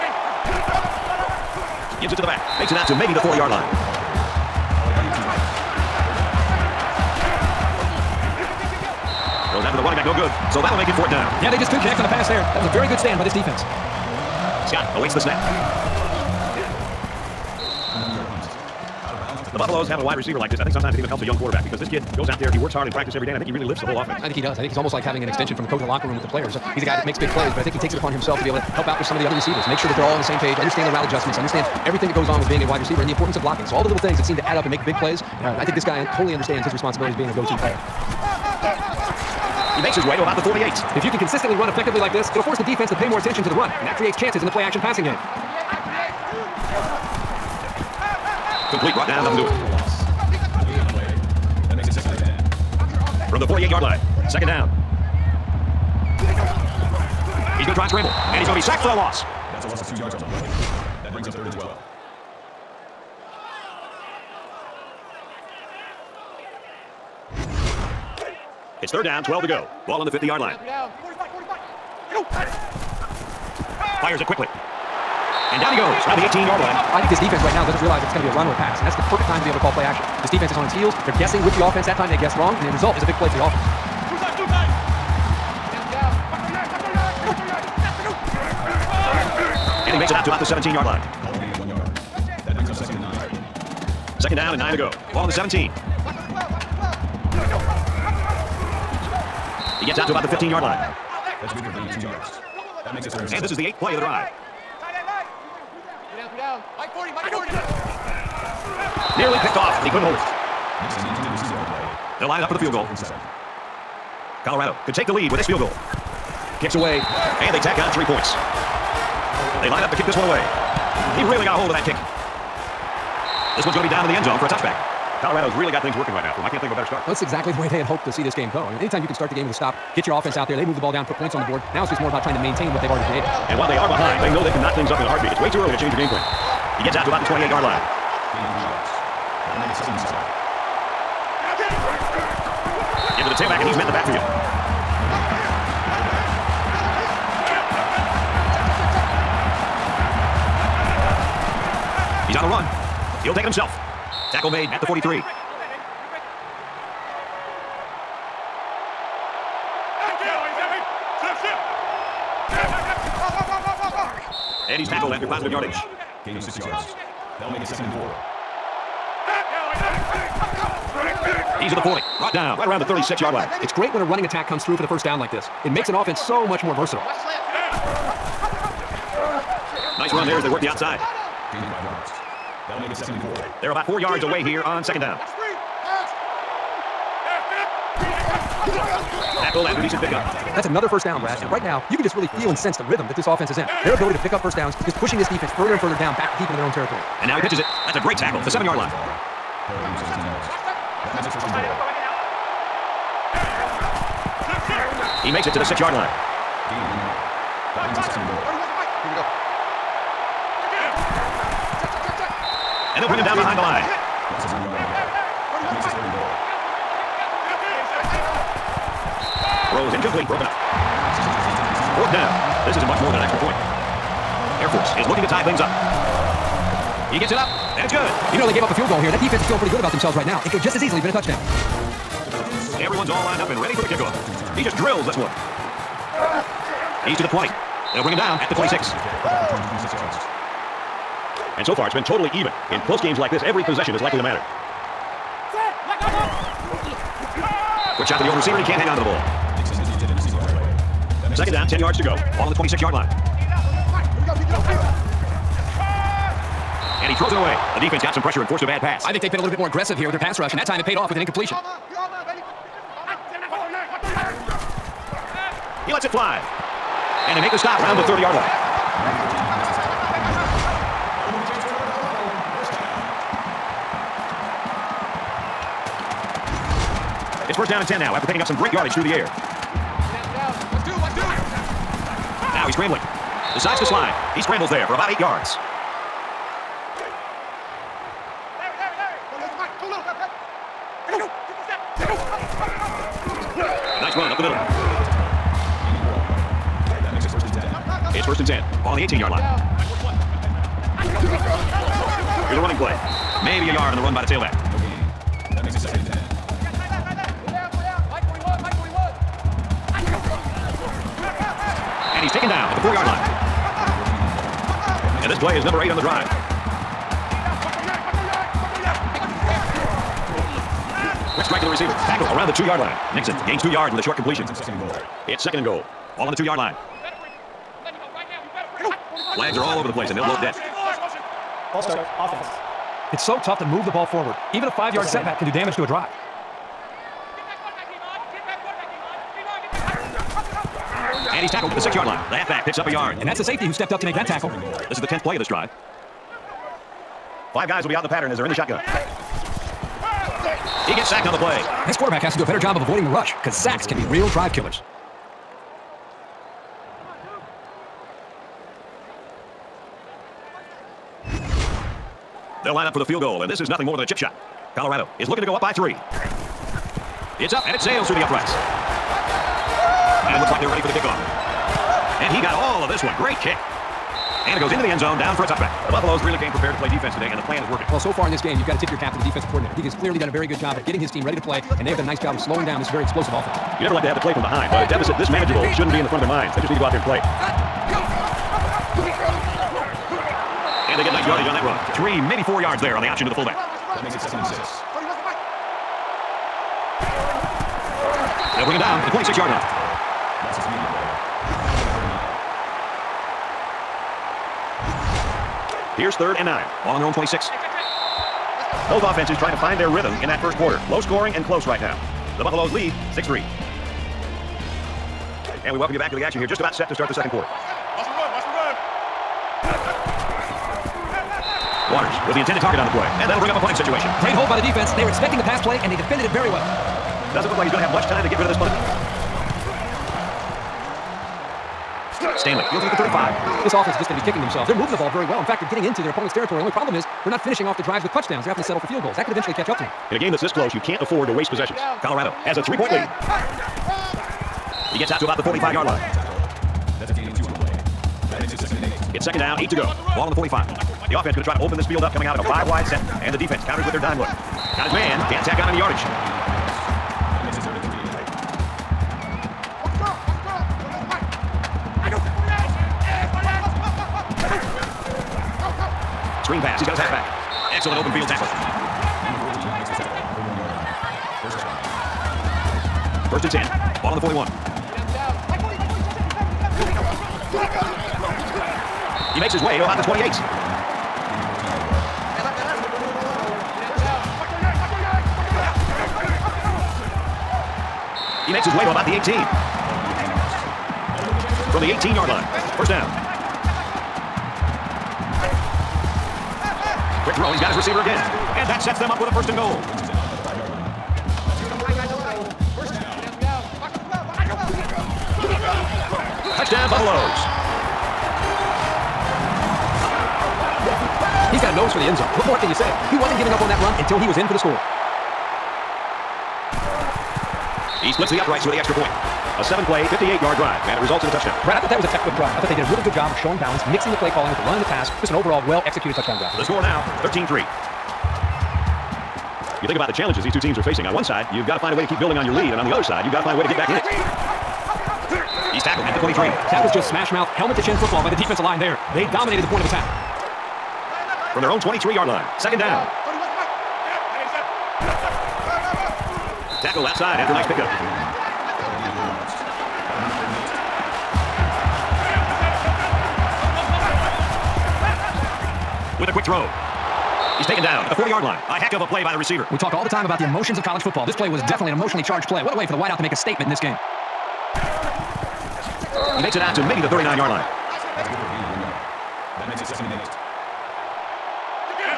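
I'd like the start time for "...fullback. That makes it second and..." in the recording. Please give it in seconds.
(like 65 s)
393 s.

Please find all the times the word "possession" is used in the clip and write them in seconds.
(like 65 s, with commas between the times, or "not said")
243 s, 441 s.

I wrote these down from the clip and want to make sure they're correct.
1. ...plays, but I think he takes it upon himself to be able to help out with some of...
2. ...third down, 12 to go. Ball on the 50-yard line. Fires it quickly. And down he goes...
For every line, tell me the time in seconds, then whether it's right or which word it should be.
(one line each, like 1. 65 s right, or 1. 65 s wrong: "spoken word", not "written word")
1. 27 s right
2. 68 s right.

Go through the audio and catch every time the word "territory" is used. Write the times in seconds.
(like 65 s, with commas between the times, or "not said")
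196 s, 436 s.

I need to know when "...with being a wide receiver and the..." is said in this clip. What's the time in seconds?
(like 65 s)
32 s.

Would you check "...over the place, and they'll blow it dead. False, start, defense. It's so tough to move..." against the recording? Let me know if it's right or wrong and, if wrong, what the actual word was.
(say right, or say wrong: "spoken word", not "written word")
wrong: "offense", not "defense".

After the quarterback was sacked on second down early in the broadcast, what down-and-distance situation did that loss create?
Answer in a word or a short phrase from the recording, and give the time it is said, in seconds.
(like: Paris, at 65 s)
third and 12, at 61 s.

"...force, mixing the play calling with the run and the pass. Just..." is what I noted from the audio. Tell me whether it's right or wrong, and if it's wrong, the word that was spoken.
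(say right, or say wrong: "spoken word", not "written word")
wrong: "balance", not "force".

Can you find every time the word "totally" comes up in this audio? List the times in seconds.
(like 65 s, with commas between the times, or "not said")
36 s, 242 s.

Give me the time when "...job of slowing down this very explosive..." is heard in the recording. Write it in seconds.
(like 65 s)
382 s.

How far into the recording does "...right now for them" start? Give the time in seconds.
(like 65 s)
126 s.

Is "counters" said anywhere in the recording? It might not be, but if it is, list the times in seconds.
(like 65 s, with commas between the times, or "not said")
453 s.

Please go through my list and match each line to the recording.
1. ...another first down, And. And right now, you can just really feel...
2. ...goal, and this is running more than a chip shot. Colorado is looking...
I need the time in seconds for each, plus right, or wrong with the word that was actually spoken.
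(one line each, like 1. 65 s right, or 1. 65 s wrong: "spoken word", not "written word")
1. 190 s wrong: "Brad", not "And"
2. 363 s wrong: "nothing", not "running".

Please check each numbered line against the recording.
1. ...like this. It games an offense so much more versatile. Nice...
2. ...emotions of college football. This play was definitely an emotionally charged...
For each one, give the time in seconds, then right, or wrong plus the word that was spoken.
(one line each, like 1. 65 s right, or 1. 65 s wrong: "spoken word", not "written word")
1. 175 s wrong: "makes", not "games"
2. 560 s right.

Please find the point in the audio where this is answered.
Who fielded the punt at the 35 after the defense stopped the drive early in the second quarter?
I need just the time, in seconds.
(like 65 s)
432 s.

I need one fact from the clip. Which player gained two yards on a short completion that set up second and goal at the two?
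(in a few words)
Nixon.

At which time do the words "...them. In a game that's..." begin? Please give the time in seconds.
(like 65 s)
439 s.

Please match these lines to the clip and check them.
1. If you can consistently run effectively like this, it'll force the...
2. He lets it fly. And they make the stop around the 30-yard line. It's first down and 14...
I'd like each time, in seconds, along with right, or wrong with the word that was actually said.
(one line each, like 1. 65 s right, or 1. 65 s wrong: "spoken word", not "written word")
1. 40 s right
2. 265 s wrong: "10", not "14".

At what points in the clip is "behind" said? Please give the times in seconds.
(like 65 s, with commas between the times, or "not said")
133 s, 213 s, 384 s.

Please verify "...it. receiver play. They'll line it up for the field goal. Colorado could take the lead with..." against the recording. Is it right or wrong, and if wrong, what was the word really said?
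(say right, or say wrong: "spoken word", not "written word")
right.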